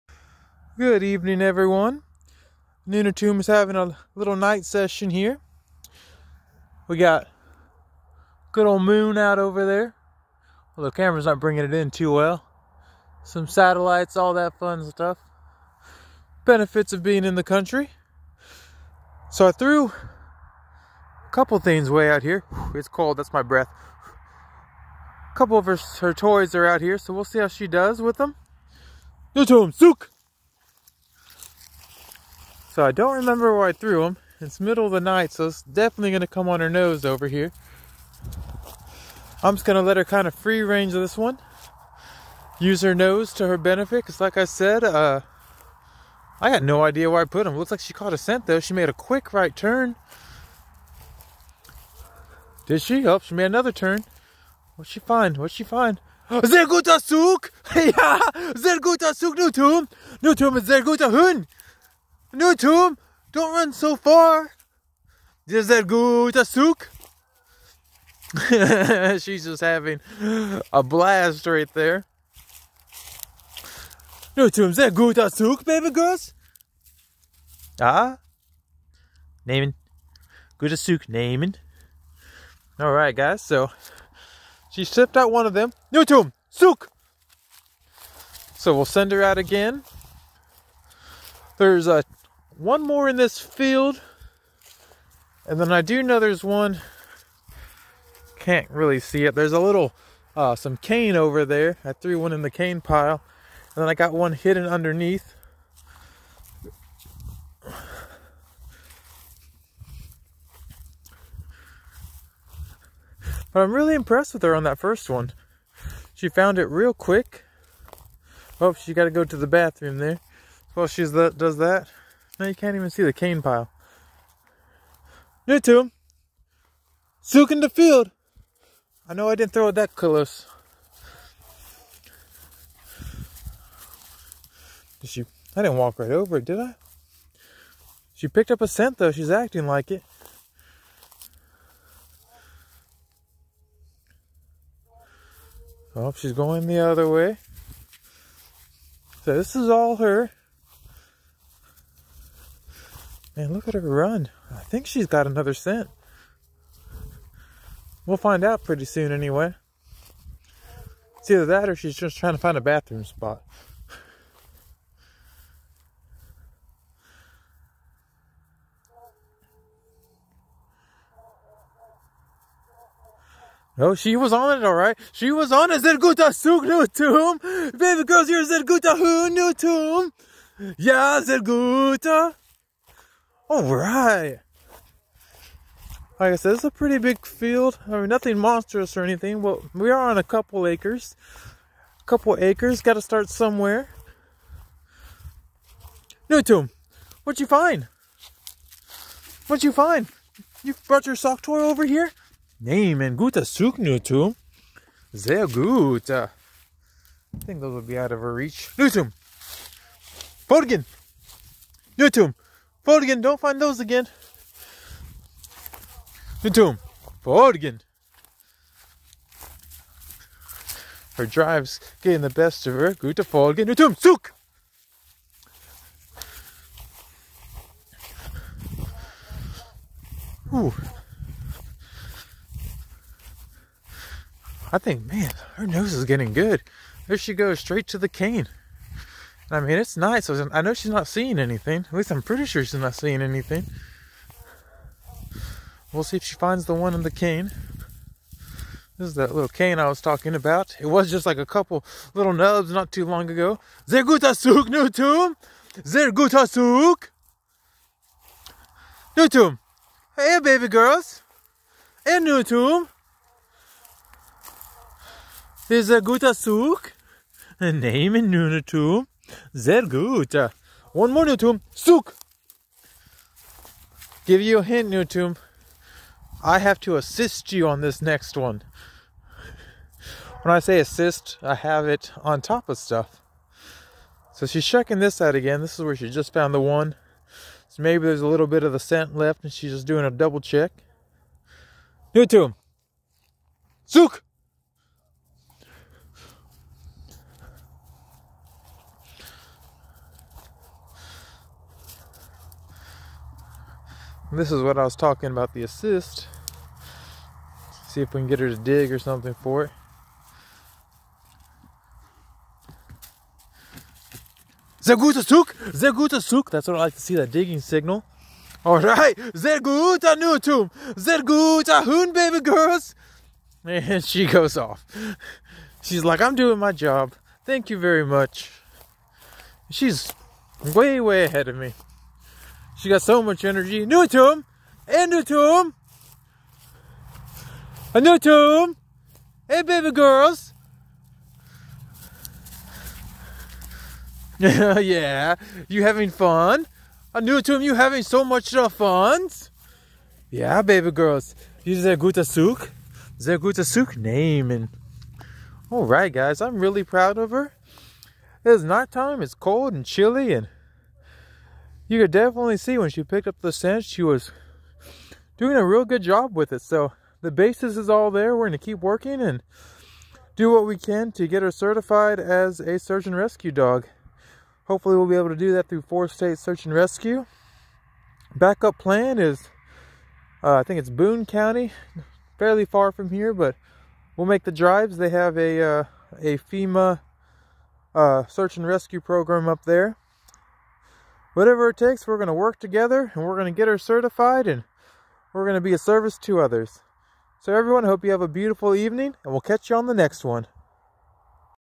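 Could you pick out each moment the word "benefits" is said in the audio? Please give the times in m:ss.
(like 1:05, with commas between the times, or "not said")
0:16, 0:43.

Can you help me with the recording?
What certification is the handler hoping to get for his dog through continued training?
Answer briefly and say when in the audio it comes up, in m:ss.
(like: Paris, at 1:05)
search and rescue dog, at 6:12.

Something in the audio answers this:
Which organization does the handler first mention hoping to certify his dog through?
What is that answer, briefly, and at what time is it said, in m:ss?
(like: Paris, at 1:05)
Four State Search and Rescue, at 6:15.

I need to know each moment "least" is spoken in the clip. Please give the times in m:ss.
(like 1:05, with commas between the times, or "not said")
4:01.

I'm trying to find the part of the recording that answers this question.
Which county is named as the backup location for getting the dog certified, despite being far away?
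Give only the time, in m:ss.
6:20.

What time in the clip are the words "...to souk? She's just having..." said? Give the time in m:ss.
1:06.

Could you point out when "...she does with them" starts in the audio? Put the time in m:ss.
0:27.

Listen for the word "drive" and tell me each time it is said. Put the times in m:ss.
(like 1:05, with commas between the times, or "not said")
3:41, 6:24.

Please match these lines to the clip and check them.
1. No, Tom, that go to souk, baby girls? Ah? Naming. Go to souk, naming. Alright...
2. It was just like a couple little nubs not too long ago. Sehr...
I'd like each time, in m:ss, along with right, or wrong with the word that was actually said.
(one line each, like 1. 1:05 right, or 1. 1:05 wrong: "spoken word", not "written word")
1. 1:14 right
2. 4:10 right.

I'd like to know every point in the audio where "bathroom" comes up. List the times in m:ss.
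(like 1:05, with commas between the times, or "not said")
1:59, 2:42.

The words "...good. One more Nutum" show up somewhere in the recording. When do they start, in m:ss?
4:29.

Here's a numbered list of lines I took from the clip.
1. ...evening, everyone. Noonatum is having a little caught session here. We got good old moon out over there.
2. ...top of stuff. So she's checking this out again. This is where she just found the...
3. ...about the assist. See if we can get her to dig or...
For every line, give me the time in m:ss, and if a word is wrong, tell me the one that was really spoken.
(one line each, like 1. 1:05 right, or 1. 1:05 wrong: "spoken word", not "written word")
1. 0:01 wrong: "night", not "caught"
2. 4:42 right
3. 5:05 right.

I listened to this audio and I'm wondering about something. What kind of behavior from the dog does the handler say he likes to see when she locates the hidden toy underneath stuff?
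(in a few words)
digging signal.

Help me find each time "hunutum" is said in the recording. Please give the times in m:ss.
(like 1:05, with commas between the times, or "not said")
2:58.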